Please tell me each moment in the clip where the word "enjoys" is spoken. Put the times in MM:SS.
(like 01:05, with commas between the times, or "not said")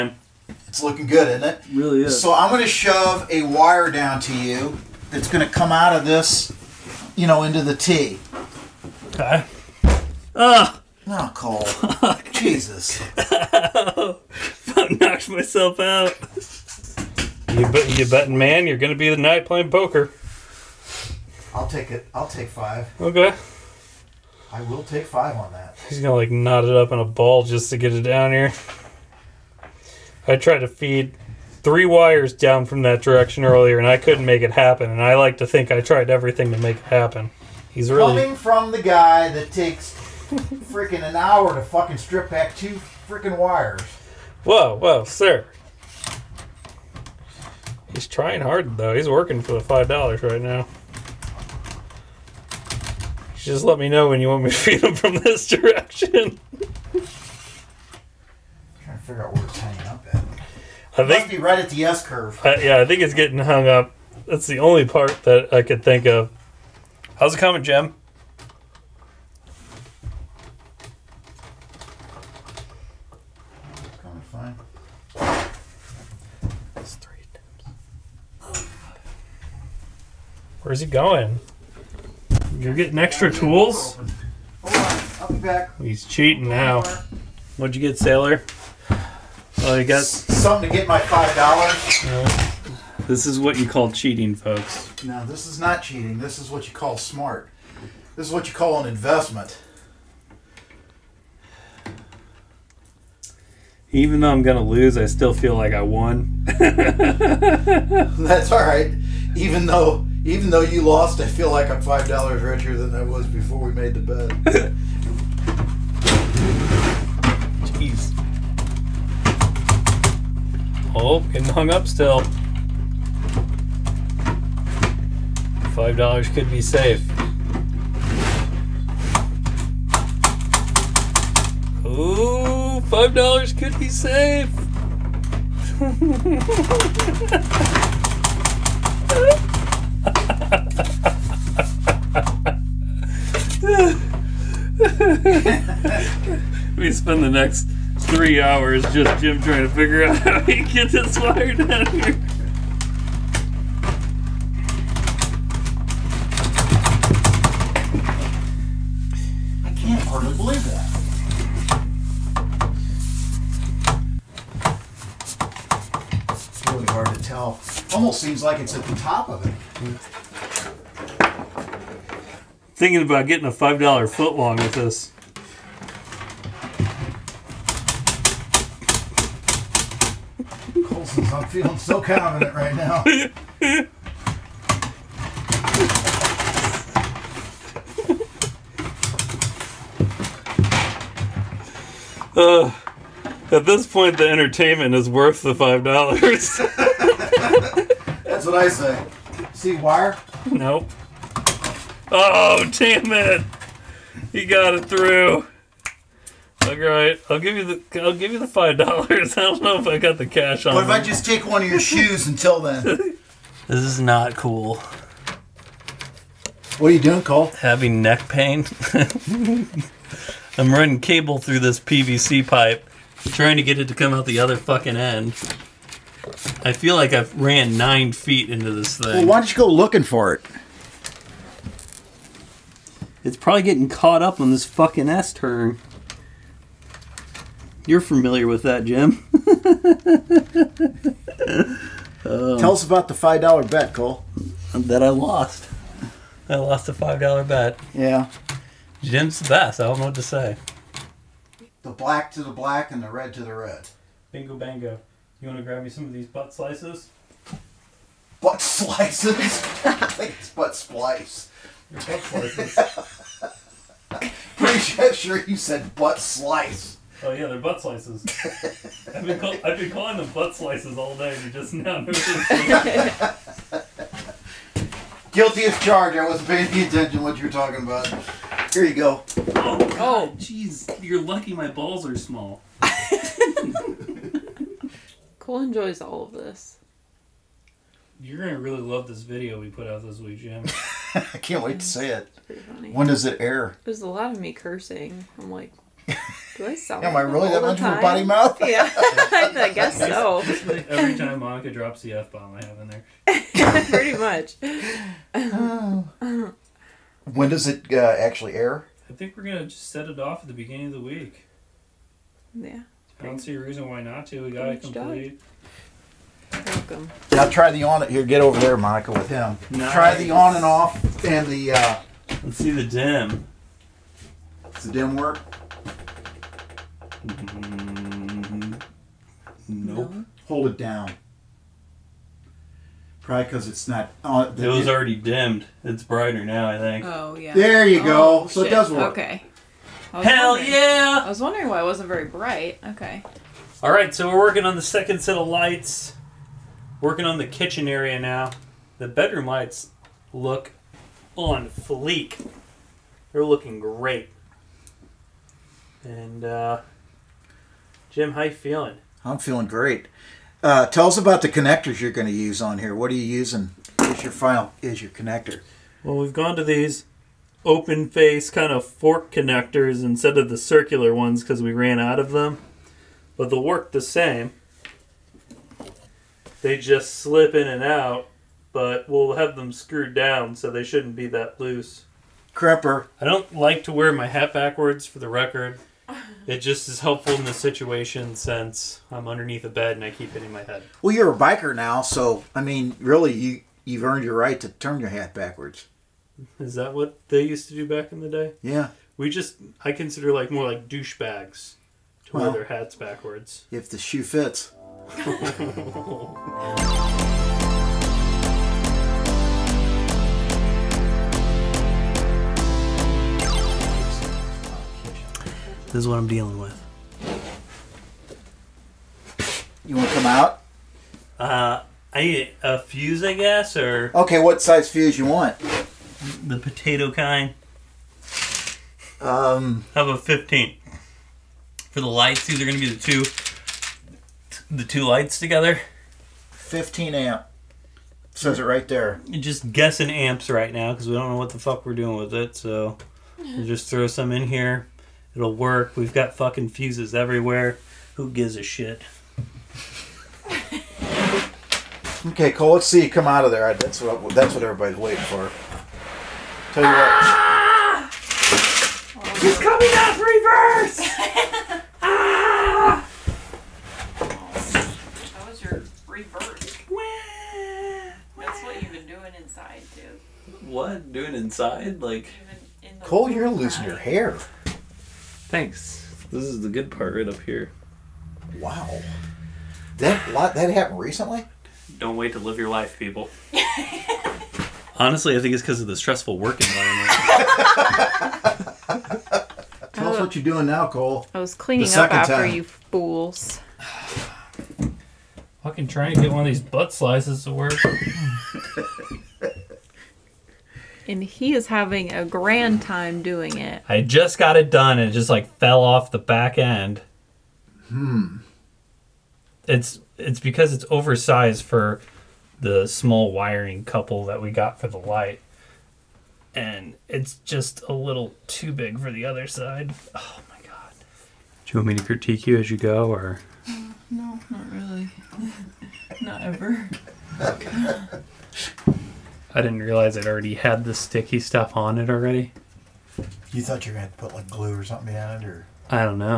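04:45.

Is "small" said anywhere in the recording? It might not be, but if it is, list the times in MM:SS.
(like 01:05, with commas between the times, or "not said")
04:42, 08:32.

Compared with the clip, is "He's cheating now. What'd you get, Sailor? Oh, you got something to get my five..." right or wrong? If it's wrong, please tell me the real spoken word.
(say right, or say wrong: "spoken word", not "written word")
right.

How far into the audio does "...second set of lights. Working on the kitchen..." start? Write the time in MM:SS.
05:44.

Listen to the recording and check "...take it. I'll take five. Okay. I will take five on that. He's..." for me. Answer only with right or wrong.
right.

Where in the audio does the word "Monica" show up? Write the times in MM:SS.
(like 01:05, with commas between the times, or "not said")
05:01, 05:18.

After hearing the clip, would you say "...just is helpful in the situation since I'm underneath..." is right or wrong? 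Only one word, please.
right.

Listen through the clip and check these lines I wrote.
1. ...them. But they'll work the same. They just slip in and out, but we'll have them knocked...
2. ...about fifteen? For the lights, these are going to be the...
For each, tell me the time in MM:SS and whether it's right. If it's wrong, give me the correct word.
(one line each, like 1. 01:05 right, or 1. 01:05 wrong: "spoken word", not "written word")
1. 06:12 wrong: "screwed", not "knocked"
2. 07:10 right.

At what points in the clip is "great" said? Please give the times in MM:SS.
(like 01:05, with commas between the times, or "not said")
05:53, 05:59.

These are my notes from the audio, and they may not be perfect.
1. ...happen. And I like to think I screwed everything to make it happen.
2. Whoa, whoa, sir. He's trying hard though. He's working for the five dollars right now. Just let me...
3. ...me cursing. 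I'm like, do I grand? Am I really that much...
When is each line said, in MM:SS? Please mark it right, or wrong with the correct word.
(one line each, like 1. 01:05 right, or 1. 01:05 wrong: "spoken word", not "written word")
1. 00:34 wrong: "tried", not "screwed"
2. 00:44 right
3. 04:54 wrong: "sound", not "grand".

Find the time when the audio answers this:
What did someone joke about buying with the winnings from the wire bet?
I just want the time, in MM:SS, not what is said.
02:53.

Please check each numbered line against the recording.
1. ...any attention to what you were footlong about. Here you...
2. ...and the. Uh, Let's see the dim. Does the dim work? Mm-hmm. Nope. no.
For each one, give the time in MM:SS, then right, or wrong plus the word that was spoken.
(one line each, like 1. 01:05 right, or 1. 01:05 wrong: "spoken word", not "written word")
1. 04:36 wrong: "talking", not "footlong"
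2. 05:21 right.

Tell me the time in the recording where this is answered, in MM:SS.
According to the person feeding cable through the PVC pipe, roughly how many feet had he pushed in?
03:47.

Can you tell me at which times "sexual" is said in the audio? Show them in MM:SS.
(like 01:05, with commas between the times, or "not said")
not said.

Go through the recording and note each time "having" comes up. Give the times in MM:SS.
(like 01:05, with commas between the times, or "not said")
03:37, 08:21.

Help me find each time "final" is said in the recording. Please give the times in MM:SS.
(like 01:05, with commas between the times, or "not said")
06:04.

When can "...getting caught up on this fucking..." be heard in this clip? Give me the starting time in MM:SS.
03:53.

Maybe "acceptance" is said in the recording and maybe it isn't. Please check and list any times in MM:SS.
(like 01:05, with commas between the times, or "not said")
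not said.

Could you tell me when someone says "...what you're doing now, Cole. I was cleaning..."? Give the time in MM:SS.
08:10.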